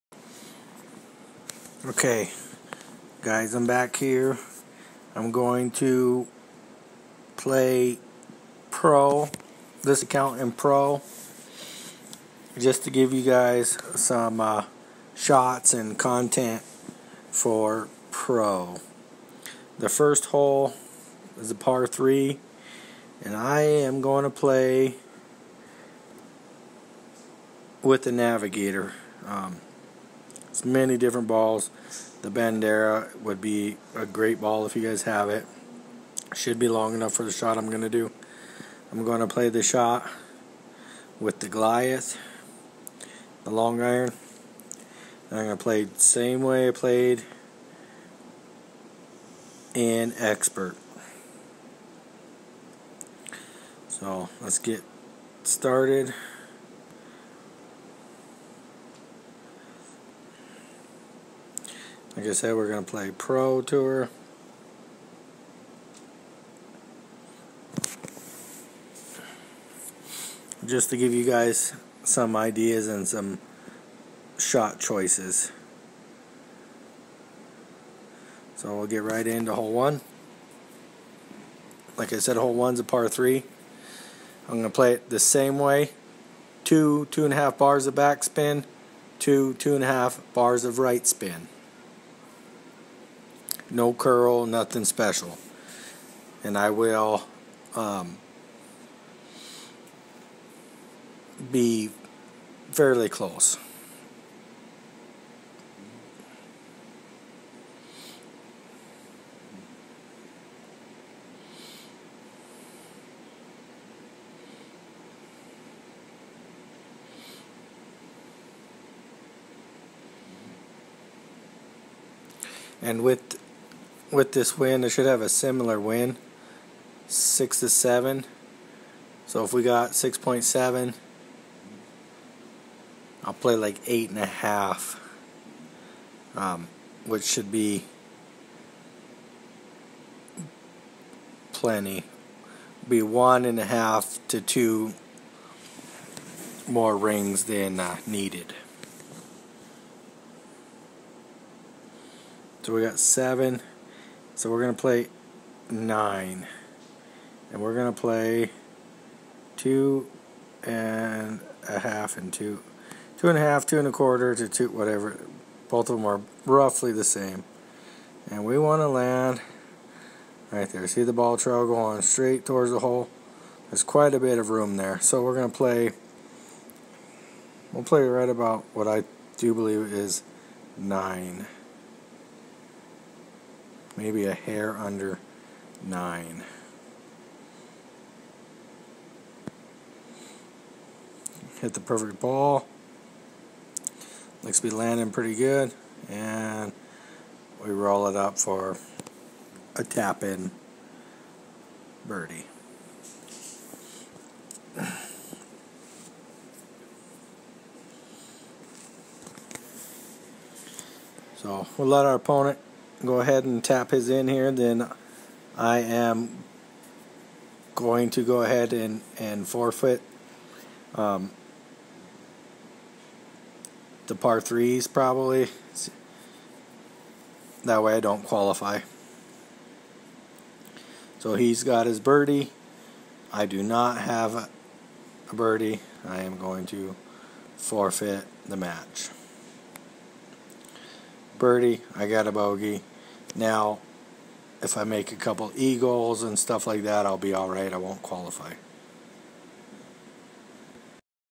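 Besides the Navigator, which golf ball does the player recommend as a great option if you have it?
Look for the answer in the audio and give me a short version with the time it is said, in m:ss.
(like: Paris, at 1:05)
Bandera, at 0:32.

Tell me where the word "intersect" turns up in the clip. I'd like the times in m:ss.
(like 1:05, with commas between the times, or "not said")
not said.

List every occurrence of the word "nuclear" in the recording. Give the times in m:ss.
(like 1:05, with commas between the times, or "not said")
not said.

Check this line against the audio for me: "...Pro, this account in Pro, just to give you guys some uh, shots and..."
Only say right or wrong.
right.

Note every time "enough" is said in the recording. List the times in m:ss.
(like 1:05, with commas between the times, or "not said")
0:36.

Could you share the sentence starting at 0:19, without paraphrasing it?
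The first hole is a par 3, and I am going to play with the Navigator.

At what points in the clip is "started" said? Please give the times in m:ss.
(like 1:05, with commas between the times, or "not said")
0:55.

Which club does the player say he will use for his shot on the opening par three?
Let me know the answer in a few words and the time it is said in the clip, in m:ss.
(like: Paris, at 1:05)
Goliath, at 0:41.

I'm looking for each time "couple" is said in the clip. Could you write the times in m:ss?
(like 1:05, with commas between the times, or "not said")
4:05.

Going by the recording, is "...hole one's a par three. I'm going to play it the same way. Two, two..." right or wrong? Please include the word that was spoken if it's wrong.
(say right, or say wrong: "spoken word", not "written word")
right.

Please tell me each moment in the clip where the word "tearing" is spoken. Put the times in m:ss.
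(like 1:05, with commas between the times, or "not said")
not said.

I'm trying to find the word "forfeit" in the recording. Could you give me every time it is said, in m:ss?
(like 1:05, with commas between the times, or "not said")
3:39, 3:57.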